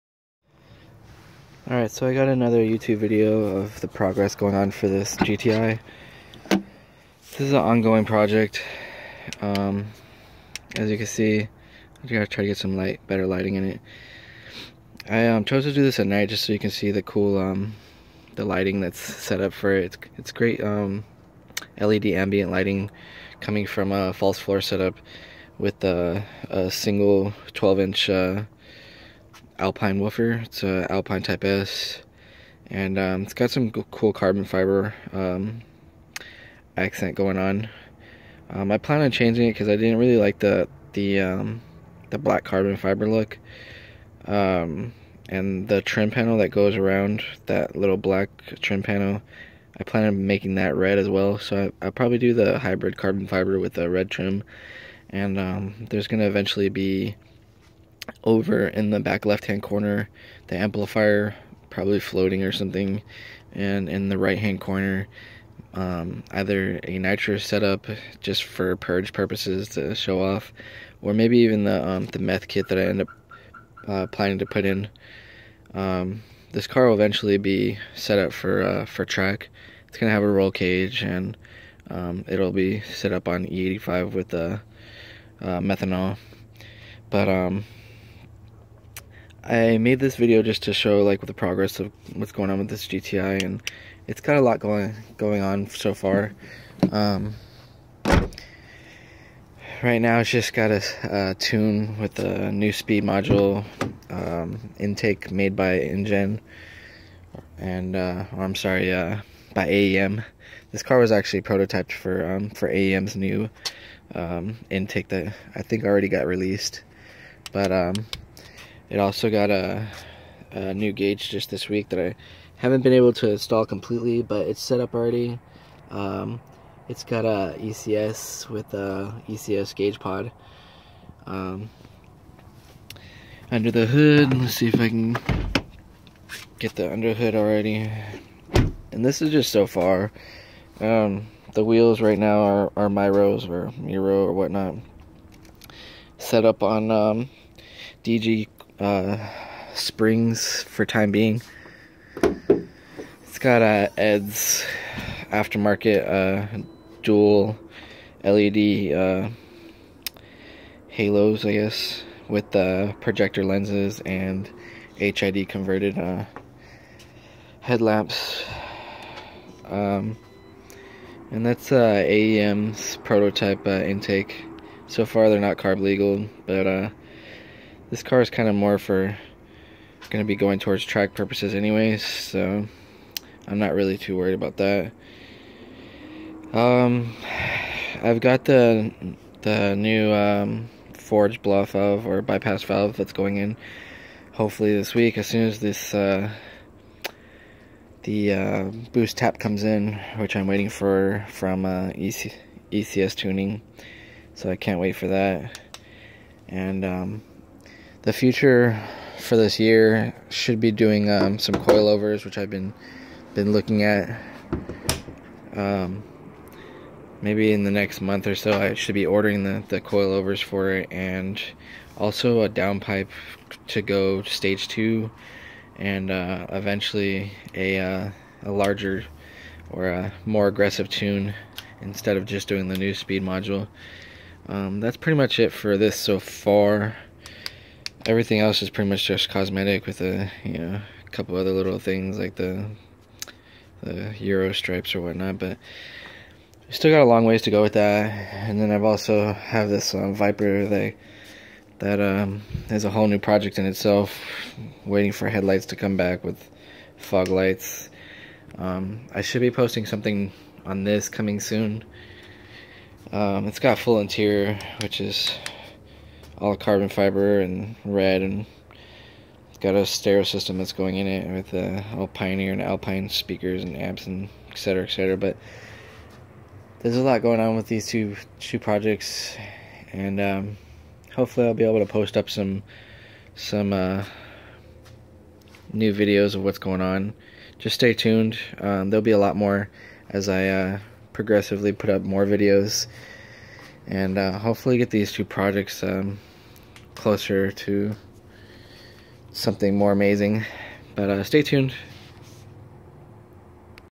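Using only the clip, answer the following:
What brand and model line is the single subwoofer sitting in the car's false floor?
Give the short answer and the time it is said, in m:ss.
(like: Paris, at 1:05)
Alpine Type S, at 0:30.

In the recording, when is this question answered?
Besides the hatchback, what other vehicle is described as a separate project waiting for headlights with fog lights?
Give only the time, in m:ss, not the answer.
4:10.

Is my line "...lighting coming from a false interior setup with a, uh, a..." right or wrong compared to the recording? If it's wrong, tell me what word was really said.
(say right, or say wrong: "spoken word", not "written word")
wrong: "floor", not "interior".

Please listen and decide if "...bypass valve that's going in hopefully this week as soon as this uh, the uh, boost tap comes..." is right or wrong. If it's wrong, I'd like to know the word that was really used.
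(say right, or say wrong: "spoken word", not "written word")
right.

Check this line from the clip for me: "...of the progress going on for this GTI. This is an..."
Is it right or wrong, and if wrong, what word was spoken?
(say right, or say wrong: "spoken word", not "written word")
right.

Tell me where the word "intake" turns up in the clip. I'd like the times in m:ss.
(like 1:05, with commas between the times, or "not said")
1:44, 1:54, 2:53.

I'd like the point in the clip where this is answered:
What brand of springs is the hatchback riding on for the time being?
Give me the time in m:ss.
2:28.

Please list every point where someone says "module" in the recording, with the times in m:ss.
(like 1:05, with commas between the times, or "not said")
1:43, 3:53.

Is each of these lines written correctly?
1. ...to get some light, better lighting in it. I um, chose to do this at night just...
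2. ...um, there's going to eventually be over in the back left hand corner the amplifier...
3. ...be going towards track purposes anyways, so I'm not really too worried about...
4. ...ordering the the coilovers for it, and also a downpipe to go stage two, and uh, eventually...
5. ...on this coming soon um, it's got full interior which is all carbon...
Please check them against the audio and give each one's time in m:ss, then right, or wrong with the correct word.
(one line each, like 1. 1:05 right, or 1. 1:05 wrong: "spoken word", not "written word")
1. 0:12 right
2. 0:55 right
3. 3:00 right
4. 3:39 right
5. 4:20 right.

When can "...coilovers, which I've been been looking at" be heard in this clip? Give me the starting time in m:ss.
3:31.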